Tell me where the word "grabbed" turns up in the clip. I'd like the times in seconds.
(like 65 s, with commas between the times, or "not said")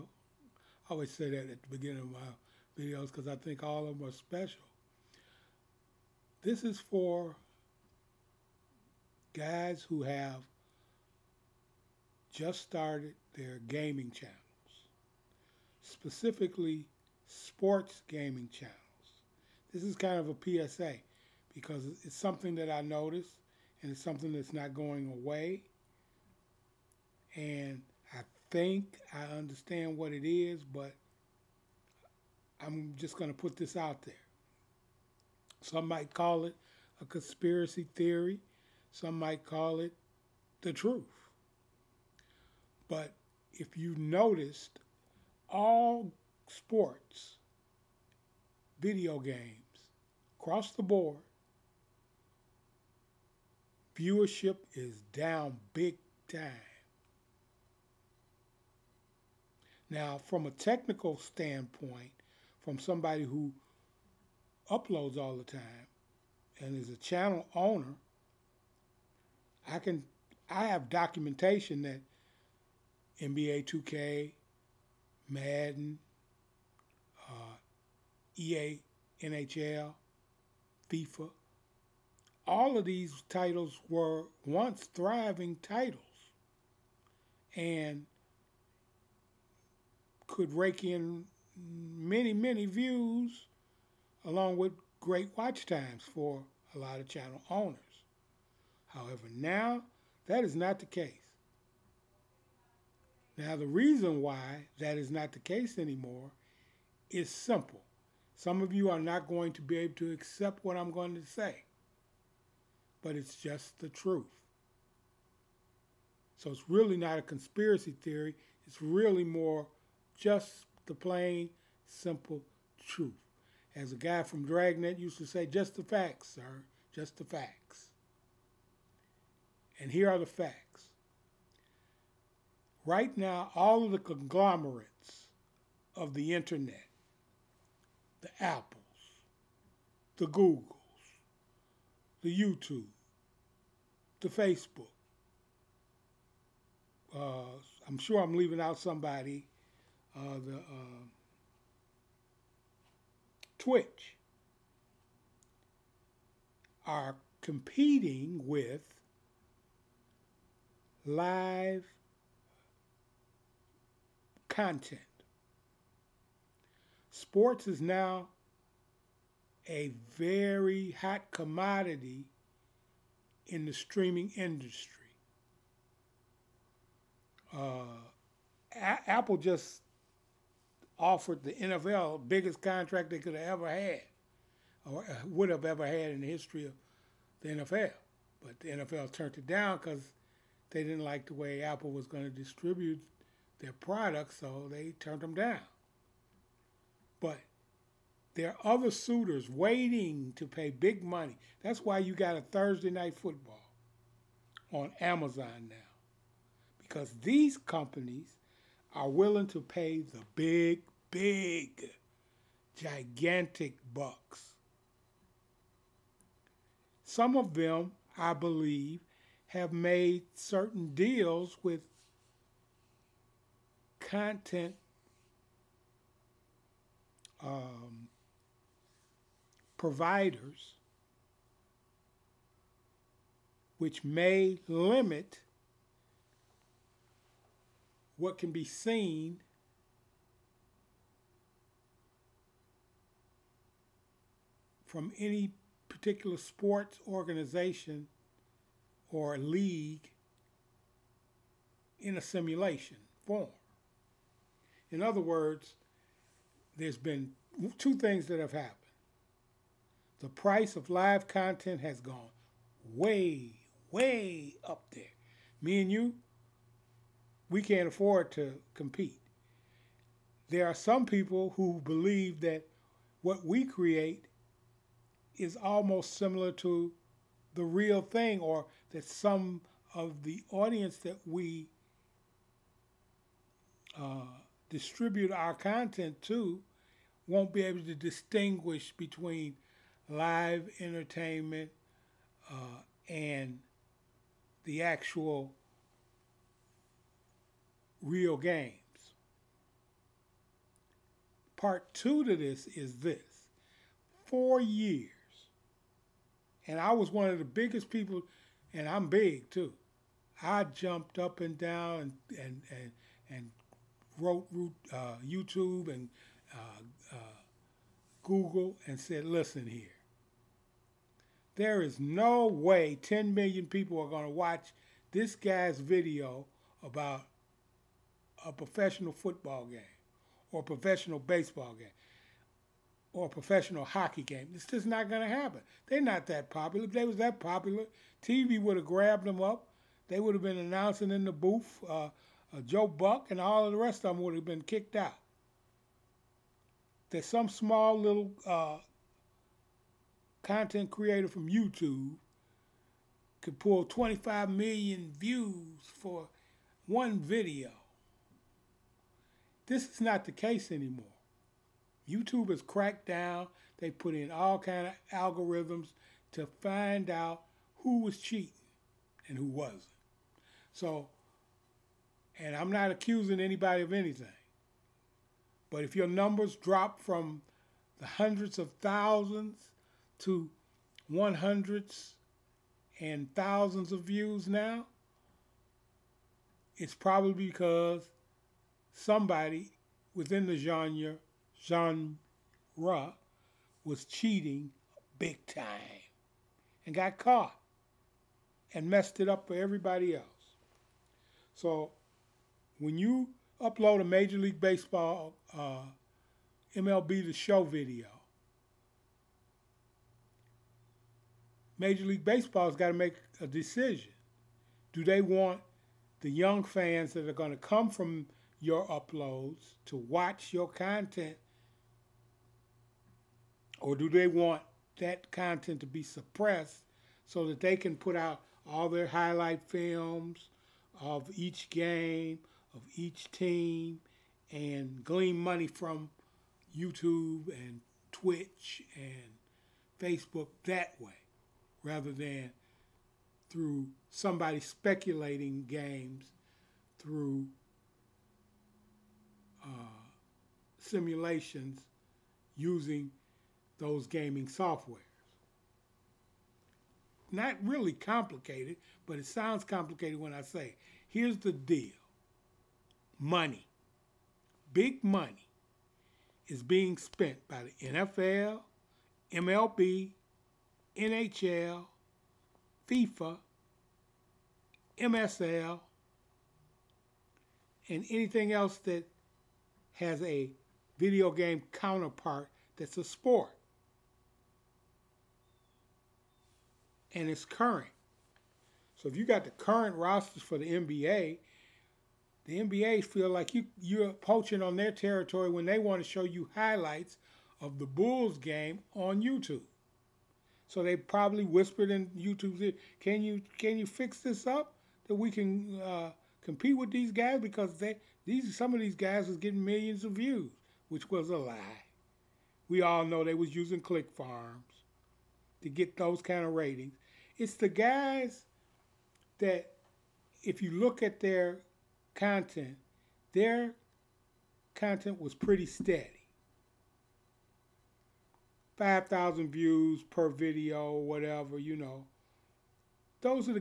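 338 s.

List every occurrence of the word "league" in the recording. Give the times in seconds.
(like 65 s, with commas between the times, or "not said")
249 s, 404 s, 412 s.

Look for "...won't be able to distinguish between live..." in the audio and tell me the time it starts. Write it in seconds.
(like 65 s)
287 s.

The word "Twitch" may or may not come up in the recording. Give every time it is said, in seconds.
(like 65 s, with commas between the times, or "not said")
153 s, 438 s.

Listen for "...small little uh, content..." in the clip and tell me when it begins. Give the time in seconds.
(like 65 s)
347 s.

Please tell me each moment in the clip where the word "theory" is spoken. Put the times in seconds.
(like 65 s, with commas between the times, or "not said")
37 s, 118 s.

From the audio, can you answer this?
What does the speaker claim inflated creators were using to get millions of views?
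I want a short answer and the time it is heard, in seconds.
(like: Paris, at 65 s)
click farms, at 513 s.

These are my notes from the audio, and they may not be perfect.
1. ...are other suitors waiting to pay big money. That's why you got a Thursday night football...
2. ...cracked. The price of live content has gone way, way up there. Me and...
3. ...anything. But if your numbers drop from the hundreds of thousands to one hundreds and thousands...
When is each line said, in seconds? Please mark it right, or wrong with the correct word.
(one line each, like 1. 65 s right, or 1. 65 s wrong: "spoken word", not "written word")
1. 198 s right
2. 258 s wrong: "happened", not "cracked"
3. 373 s right.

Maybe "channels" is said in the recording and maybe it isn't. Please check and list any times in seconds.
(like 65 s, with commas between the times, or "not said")
14 s, 18 s, 66 s, 97 s.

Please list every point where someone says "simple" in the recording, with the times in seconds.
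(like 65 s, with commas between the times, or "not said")
107 s, 121 s.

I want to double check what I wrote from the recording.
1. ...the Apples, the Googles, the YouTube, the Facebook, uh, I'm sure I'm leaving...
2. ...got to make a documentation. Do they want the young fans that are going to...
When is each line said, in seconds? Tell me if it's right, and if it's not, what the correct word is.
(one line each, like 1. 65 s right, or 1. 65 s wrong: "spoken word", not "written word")
1. 138 s right
2. 412 s wrong: "decision", not "documentation".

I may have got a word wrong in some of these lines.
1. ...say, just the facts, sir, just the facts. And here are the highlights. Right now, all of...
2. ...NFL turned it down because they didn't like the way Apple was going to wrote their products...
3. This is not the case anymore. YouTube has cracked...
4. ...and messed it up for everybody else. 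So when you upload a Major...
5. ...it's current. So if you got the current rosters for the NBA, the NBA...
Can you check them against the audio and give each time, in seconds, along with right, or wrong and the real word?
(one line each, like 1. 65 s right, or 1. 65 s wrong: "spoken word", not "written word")
1. 125 s wrong: "facts", not "highlights"
2. 188 s wrong: "distribute", not "wrote"
3. 359 s right
4. 398 s right
5. 487 s right.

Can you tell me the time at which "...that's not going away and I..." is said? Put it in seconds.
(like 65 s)
24 s.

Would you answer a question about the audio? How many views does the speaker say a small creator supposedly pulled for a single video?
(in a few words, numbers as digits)
25 million.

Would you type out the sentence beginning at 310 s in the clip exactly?
I jumped up and down and, and, and, and wrote uh, YouTube and uh, uh, Google and said, listen here.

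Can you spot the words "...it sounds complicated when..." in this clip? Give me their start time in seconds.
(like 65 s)
459 s.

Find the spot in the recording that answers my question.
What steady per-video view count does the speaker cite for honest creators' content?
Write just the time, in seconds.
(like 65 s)
528 s.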